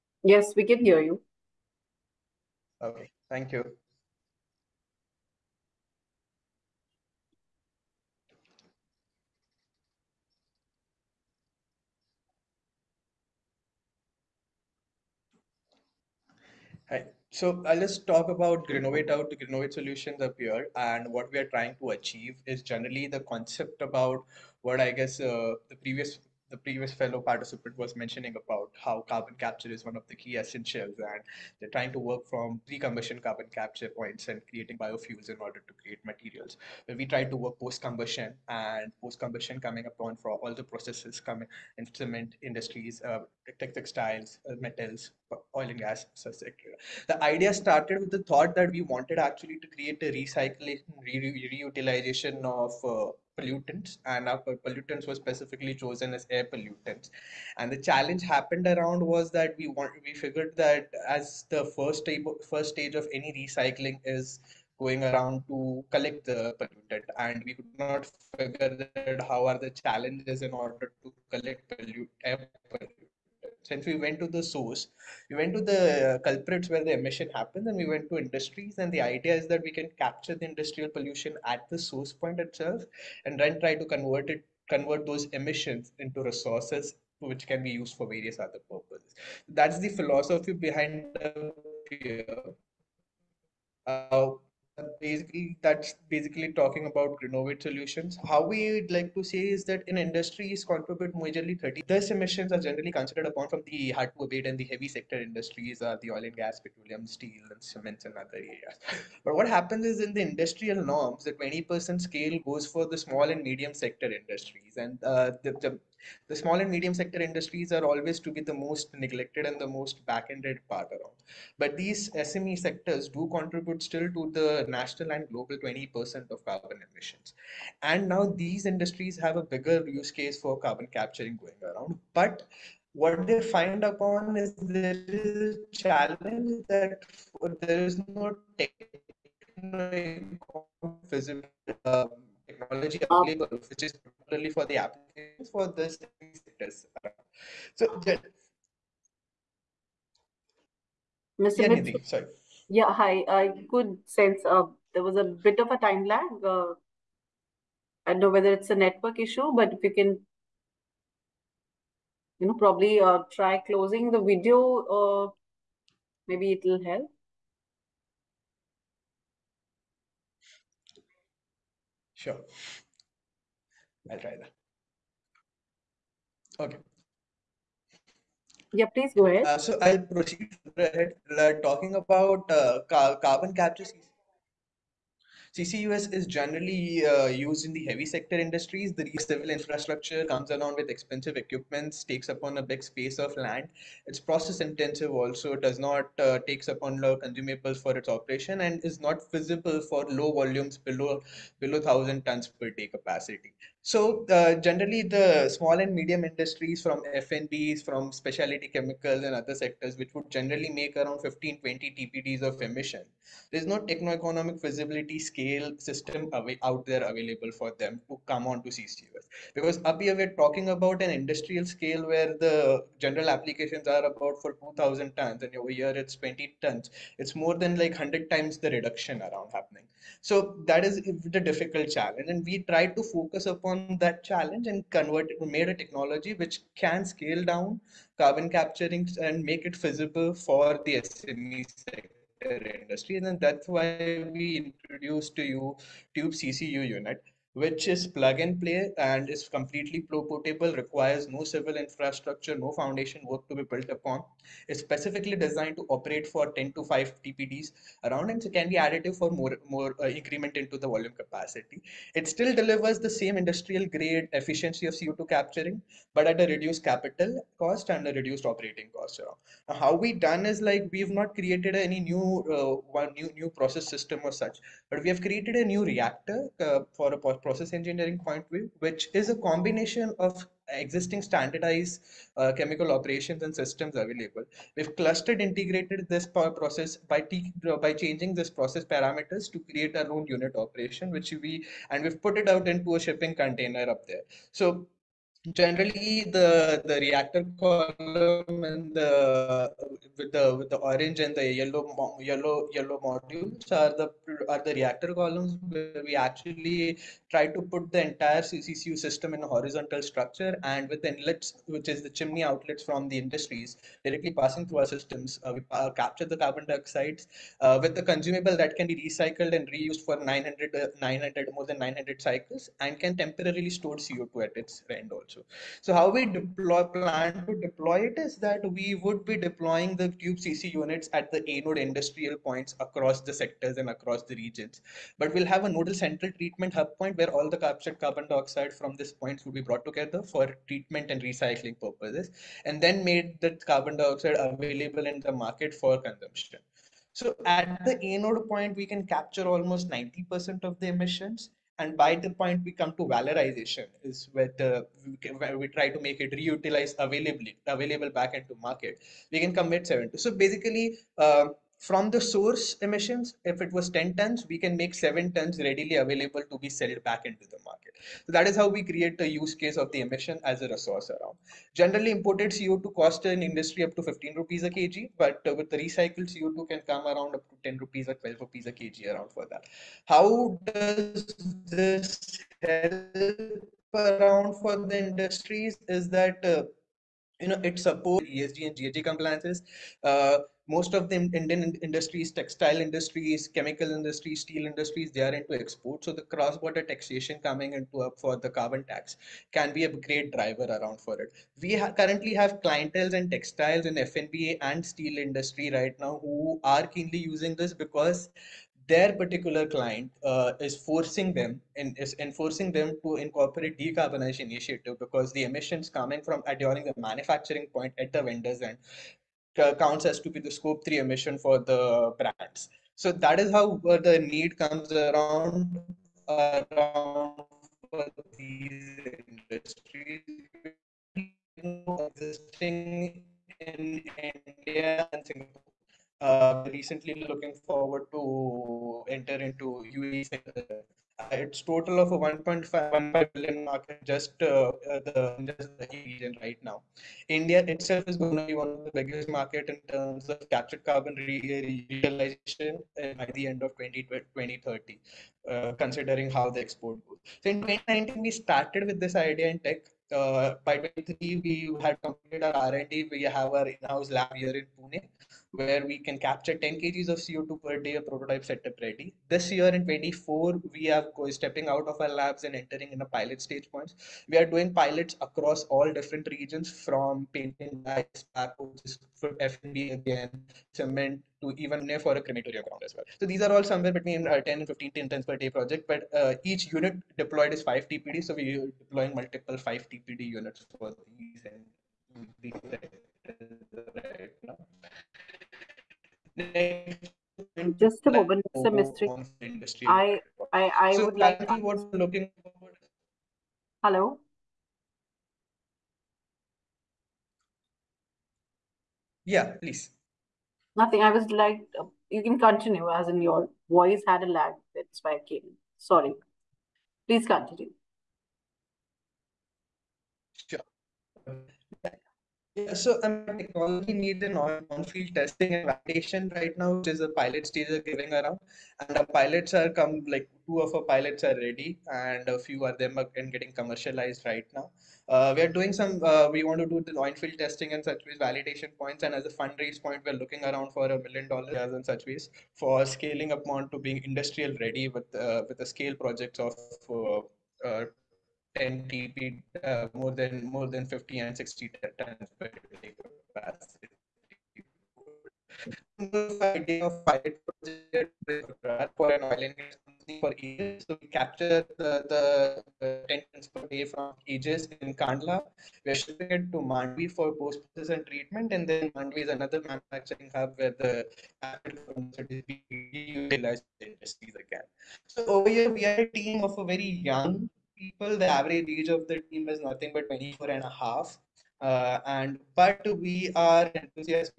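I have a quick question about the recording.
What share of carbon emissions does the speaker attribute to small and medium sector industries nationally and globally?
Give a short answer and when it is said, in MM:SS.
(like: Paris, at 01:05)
20%, at 02:05.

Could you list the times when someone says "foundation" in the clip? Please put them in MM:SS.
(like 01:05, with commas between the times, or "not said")
04:12.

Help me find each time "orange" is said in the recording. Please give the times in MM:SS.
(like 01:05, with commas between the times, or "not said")
05:00.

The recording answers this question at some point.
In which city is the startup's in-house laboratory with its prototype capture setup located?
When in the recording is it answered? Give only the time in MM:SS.
07:44.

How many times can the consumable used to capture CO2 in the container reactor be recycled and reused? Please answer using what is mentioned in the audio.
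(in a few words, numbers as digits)
More than 900.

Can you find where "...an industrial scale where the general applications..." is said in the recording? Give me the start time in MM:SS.
03:41.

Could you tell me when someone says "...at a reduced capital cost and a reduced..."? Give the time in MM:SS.
04:26.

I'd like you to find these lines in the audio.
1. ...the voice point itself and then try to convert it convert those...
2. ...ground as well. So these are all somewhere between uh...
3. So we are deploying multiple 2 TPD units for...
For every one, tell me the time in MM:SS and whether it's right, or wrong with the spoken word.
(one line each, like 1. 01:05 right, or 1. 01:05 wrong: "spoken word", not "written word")
1. 01:21 wrong: "source", not "voice"
2. 08:02 right
3. 08:08 wrong: "5", not "2".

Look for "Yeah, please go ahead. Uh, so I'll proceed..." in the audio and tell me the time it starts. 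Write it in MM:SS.
02:58.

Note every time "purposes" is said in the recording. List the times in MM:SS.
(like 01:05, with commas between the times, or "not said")
01:28, 05:41.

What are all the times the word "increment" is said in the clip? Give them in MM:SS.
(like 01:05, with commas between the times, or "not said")
04:20.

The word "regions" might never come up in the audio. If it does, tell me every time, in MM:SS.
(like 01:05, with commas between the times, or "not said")
05:34, 07:25, 07:56.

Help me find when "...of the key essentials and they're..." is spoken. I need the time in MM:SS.
00:29.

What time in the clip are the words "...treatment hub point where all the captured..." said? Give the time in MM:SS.
05:36.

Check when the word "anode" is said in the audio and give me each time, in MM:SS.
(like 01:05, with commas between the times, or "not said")
05:31, 05:48.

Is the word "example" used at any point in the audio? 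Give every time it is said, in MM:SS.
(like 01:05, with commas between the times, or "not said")
not said.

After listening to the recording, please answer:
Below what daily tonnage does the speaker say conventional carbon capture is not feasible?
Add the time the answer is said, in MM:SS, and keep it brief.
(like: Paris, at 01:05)
1000 tons per day, at 03:21.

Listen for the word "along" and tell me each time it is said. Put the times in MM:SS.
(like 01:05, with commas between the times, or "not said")
03:10.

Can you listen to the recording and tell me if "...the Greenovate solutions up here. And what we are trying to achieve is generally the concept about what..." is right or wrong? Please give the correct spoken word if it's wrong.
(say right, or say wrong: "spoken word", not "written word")
right.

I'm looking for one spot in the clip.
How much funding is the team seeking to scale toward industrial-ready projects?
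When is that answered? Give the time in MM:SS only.
09:00.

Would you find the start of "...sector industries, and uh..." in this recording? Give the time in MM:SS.
01:53.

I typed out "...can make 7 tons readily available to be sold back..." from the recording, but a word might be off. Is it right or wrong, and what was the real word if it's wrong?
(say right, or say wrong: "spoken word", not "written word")
right.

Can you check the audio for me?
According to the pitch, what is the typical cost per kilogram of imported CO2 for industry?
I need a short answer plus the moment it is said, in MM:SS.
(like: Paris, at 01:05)
15 rupees, at 06:14.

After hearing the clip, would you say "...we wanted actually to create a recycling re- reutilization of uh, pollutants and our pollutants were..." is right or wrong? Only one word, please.
right.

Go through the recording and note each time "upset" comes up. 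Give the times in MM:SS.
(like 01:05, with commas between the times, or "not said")
not said.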